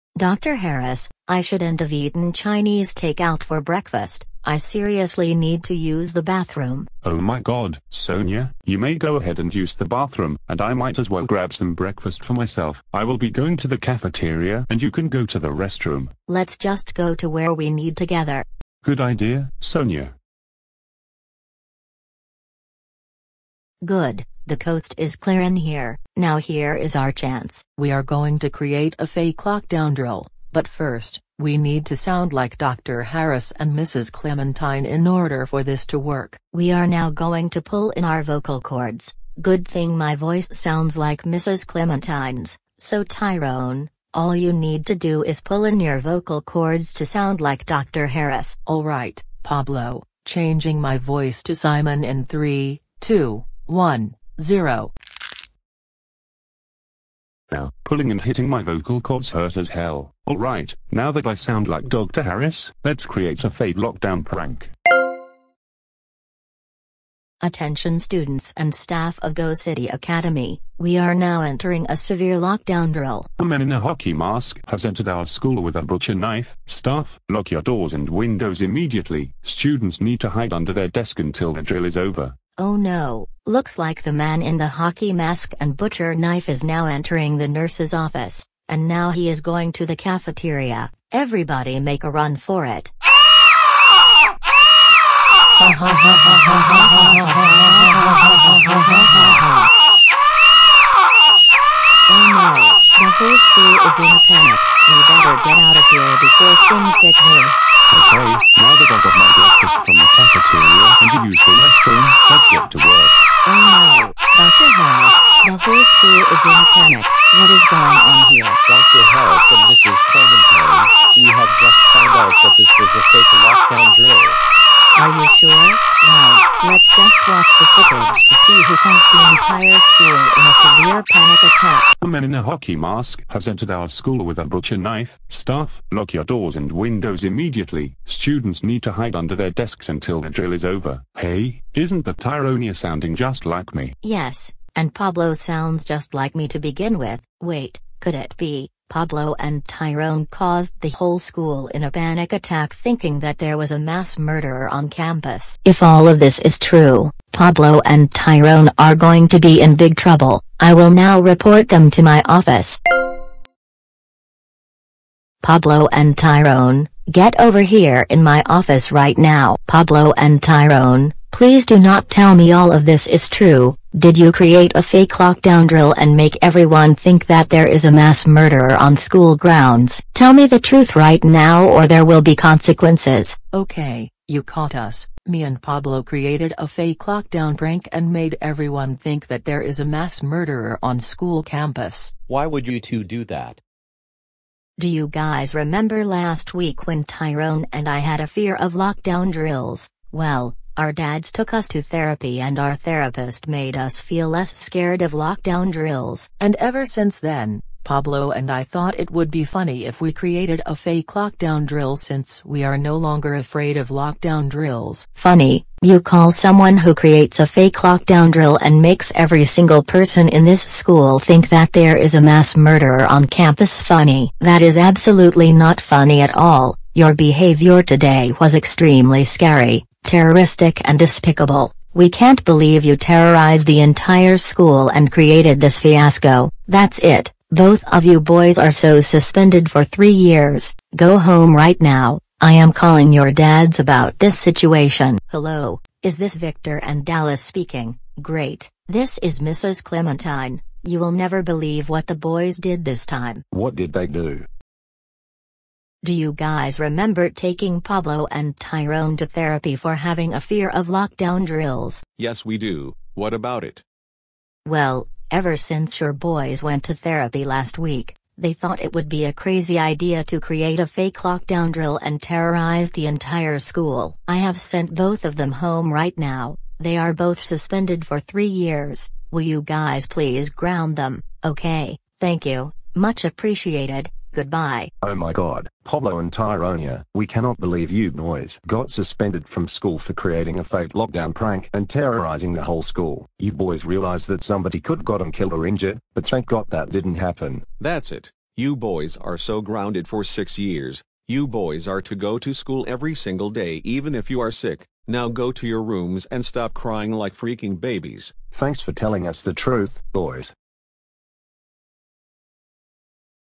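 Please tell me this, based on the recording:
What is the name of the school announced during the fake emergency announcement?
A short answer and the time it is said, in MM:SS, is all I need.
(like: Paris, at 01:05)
Go City Academy, at 01:09.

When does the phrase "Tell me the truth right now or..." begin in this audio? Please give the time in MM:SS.
03:00.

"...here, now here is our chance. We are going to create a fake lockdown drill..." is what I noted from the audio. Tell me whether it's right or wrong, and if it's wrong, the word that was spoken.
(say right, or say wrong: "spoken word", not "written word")
right.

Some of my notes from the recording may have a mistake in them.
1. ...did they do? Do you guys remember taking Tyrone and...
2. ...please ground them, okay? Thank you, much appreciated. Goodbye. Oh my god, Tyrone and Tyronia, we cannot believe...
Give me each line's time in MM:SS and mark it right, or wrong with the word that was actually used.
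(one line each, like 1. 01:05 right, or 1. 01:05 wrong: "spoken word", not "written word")
1. 04:13 wrong: "Pablo", not "Tyrone"
2. 04:40 wrong: "Pablo", not "Tyrone".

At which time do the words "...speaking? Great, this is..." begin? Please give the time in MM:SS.
04:07.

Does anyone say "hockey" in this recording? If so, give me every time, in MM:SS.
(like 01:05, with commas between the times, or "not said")
01:13, 01:24, 02:12.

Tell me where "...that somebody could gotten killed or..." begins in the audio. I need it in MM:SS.
04:54.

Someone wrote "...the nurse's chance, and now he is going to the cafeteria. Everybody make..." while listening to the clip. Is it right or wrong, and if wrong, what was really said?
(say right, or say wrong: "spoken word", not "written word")
wrong: "office", not "chance".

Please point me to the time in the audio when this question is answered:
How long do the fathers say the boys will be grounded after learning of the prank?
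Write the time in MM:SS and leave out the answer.
05:00.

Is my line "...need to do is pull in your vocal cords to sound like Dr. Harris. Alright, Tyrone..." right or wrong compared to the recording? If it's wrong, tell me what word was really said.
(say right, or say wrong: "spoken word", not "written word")
wrong: "Pablo", not "Tyrone".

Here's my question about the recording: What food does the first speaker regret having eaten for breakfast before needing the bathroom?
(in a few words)
Chinese takeout.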